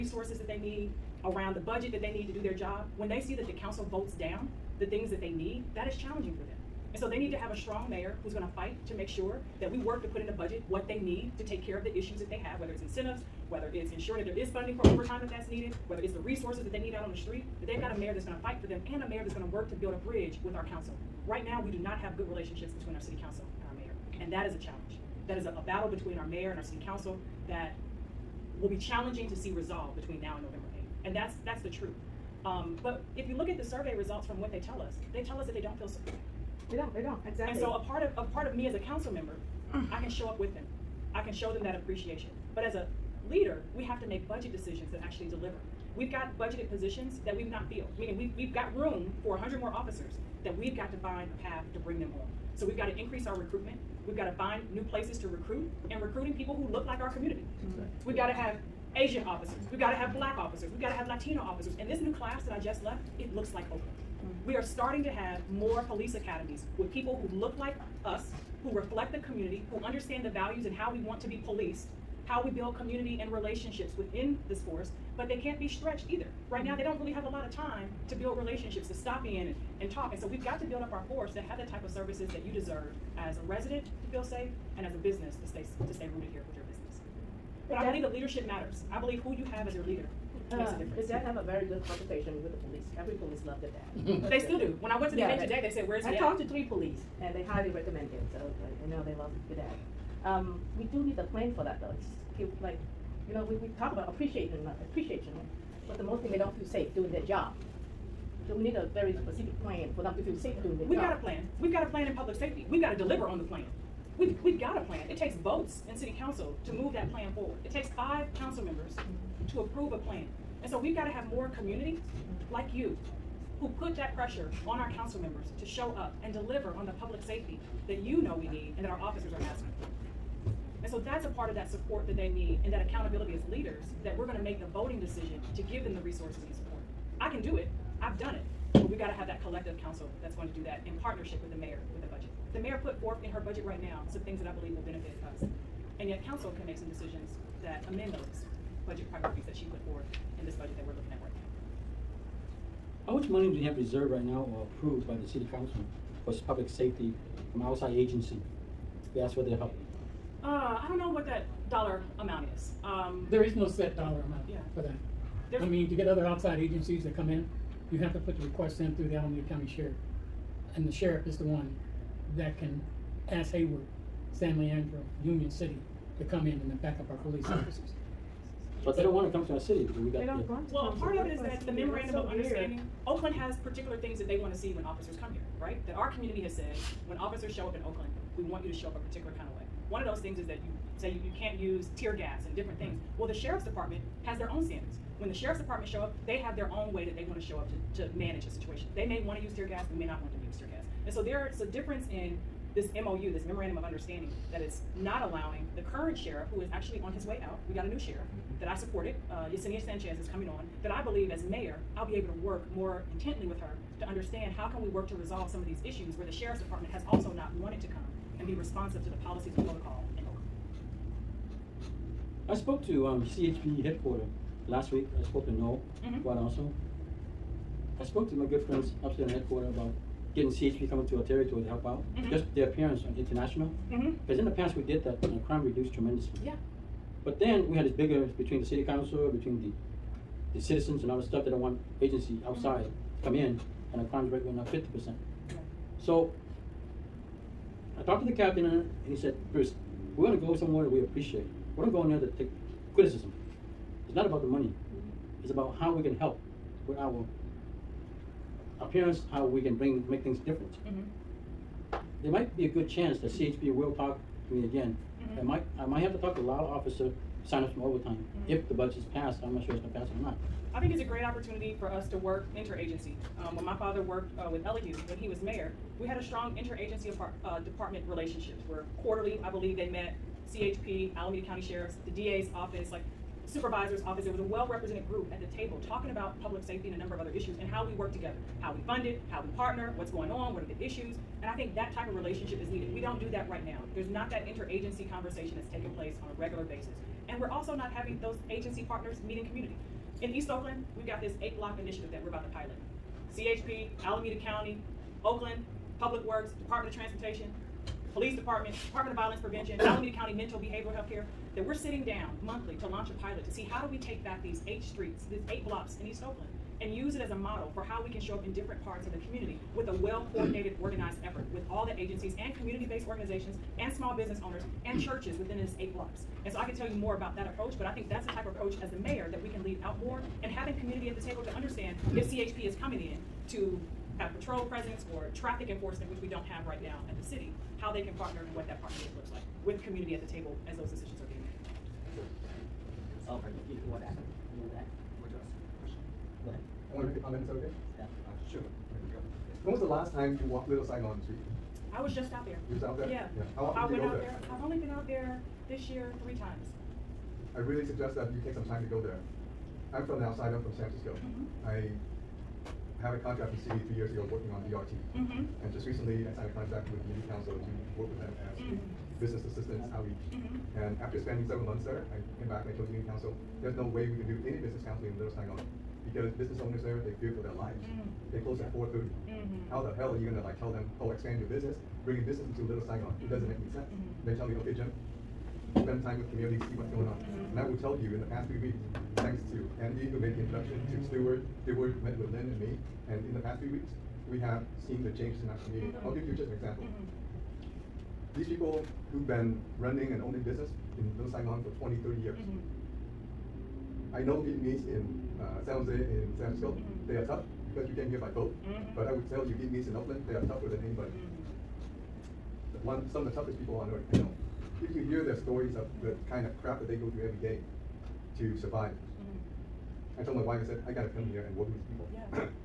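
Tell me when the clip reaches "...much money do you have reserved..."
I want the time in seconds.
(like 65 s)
153 s.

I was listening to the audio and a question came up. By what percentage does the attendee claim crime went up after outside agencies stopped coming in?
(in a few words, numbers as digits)
50 percent.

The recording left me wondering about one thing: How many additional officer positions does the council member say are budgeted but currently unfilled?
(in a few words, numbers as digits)
100.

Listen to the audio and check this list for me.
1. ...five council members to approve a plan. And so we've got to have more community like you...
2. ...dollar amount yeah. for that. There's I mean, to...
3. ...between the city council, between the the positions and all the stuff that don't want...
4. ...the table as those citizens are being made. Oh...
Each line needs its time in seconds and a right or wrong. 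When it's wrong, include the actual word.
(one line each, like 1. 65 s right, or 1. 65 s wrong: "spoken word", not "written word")
1. 117 s right
2. 163 s right
3. 238 s wrong: "citizens", not "positions"
4. 340 s wrong: "decisions", not "citizens".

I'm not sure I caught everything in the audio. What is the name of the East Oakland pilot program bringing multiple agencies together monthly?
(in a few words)
Eight block initiative.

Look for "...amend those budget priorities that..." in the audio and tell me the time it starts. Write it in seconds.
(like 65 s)
147 s.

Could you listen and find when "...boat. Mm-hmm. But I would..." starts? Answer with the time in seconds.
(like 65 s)
408 s.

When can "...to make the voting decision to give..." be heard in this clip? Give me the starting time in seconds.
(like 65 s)
134 s.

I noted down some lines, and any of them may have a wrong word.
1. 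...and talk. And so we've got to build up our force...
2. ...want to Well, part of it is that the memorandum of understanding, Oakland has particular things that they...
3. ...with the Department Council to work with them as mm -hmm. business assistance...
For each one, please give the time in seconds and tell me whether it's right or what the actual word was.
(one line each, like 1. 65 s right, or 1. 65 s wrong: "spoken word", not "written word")
1. 79 s right
2. 180 s right
3. 366 s wrong: "Unity", not "Department".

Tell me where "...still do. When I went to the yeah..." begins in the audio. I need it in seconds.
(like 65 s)
94 s.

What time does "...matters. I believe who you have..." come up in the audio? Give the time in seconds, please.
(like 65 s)
88 s.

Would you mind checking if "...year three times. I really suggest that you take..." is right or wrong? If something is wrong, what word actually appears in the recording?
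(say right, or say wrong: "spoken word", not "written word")
right.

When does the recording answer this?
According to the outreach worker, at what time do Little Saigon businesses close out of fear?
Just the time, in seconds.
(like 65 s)
378 s.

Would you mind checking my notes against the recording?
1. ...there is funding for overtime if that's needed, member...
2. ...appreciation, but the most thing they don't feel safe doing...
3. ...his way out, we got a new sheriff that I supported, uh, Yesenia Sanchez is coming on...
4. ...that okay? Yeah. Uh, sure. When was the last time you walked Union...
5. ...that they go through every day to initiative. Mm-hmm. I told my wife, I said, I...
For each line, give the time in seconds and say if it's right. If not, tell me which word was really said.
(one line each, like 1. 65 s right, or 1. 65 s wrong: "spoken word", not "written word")
1. 14 s wrong: "whether", not "member"
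2. 104 s right
3. 207 s right
4. 347 s wrong: "Little", not "Union"
5. 416 s wrong: "survive", not "initiative".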